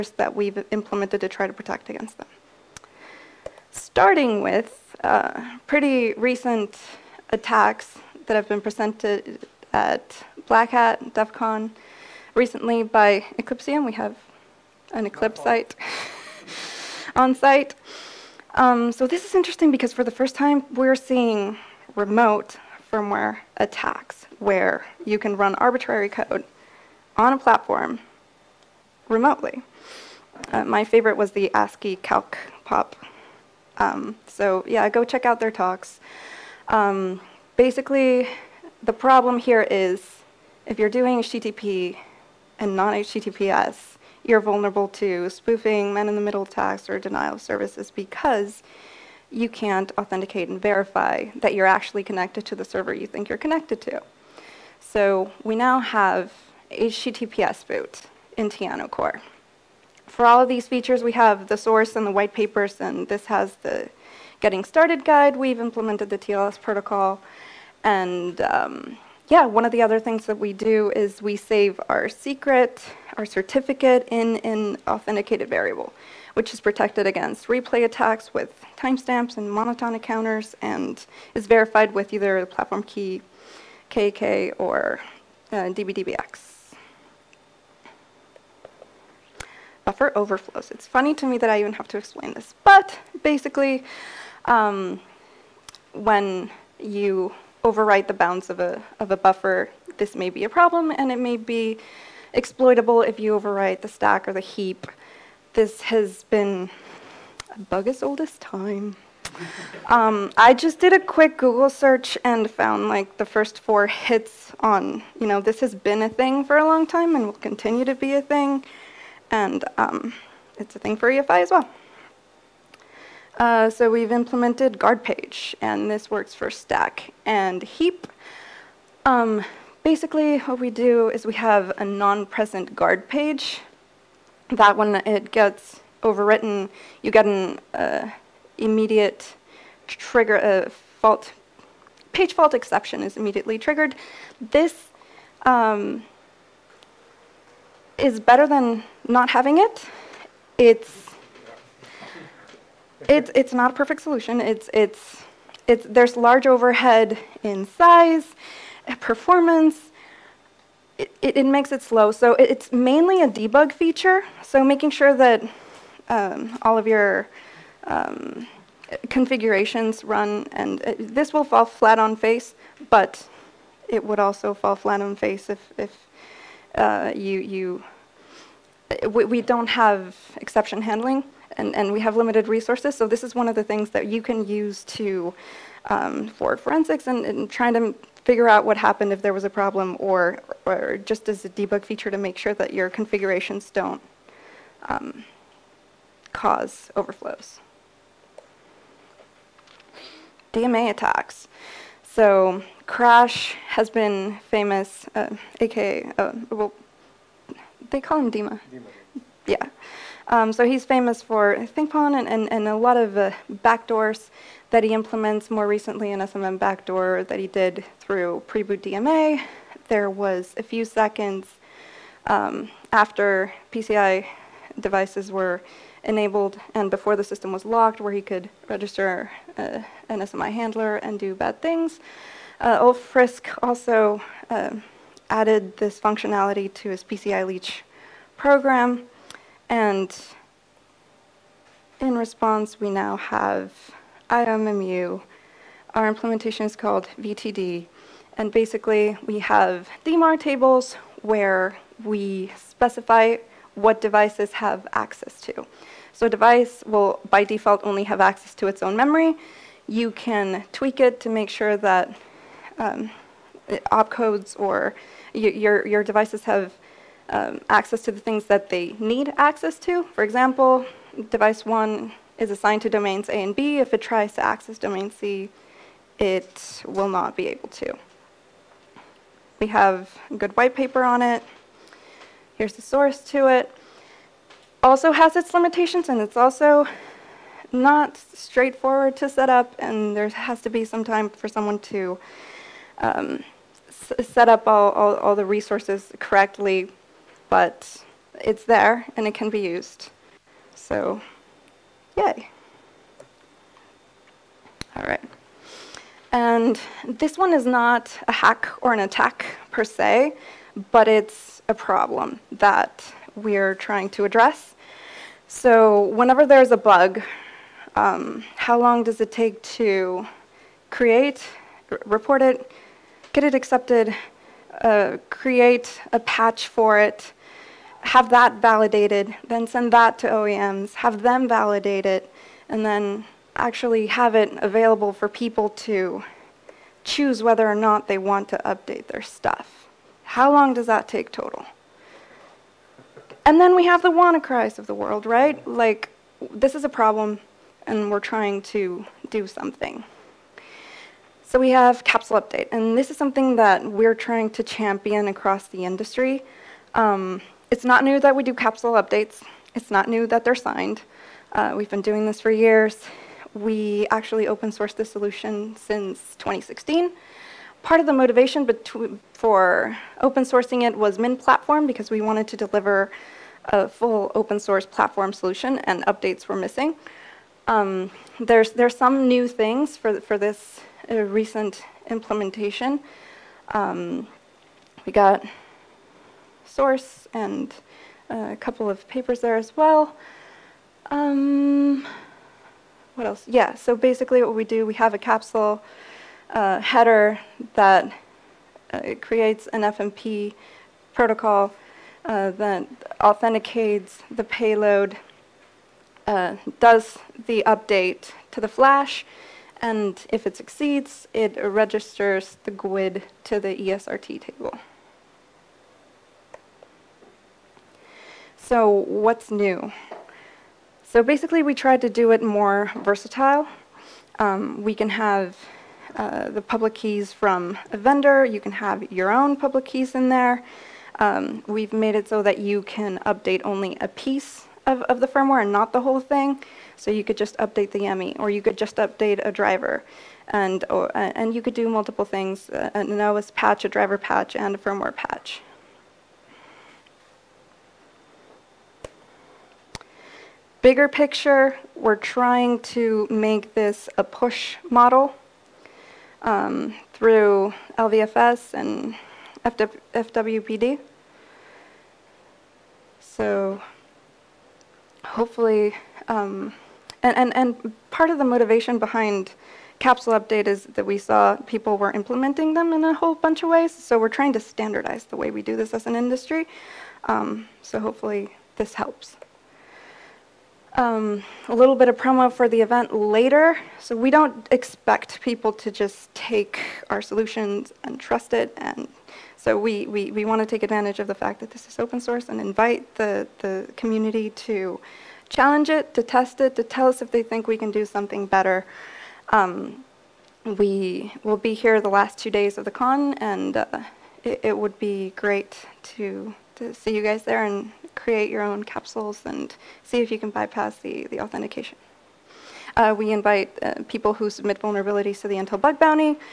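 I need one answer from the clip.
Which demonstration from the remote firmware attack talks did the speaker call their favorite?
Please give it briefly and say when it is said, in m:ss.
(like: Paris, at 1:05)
ASCII calc pop, at 0:31.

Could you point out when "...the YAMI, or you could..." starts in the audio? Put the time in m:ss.
7:17.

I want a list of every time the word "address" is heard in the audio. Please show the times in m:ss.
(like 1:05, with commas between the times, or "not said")
5:14.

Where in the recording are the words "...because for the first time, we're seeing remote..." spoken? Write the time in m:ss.
0:19.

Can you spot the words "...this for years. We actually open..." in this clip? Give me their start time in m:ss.
6:02.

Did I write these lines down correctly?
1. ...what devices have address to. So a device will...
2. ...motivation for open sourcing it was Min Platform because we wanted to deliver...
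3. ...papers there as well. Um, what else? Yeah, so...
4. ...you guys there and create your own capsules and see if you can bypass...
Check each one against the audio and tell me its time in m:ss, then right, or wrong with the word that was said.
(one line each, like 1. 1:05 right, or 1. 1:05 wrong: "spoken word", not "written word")
1. 4:13 wrong: "access", not "address"
2. 6:08 right
3. 6:29 right
4. 8:27 right.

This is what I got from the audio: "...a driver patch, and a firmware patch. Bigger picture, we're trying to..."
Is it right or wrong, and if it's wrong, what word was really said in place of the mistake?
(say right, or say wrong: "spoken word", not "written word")
right.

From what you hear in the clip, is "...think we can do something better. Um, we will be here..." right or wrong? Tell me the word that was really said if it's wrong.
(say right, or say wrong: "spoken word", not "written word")
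right.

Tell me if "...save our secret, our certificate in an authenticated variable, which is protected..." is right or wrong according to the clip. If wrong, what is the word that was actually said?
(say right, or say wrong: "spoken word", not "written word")
right.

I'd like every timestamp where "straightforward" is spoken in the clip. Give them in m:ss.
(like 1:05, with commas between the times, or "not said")
4:48.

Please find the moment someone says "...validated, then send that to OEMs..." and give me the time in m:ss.
5:28.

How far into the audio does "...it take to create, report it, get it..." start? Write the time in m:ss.
5:19.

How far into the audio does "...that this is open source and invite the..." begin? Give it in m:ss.
8:11.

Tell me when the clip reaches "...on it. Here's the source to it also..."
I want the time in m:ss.
4:41.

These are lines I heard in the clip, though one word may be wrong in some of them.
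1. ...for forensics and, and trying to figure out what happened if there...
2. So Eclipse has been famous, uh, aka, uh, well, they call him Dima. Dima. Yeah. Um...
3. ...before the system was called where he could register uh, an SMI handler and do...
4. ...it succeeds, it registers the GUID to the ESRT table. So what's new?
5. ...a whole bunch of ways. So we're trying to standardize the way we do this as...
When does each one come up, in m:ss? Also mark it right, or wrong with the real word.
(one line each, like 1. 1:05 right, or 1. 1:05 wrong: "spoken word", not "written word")
1. 3:06 right
2. 3:22 wrong: "Crash", not "Eclipse"
3. 3:46 wrong: "locked", not "called"
4. 6:50 right
5. 7:53 right.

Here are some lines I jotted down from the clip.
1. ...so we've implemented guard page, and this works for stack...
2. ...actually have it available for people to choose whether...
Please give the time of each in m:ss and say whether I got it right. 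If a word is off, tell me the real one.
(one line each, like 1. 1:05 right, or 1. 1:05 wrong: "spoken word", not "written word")
1. 2:03 right
2. 5:33 right.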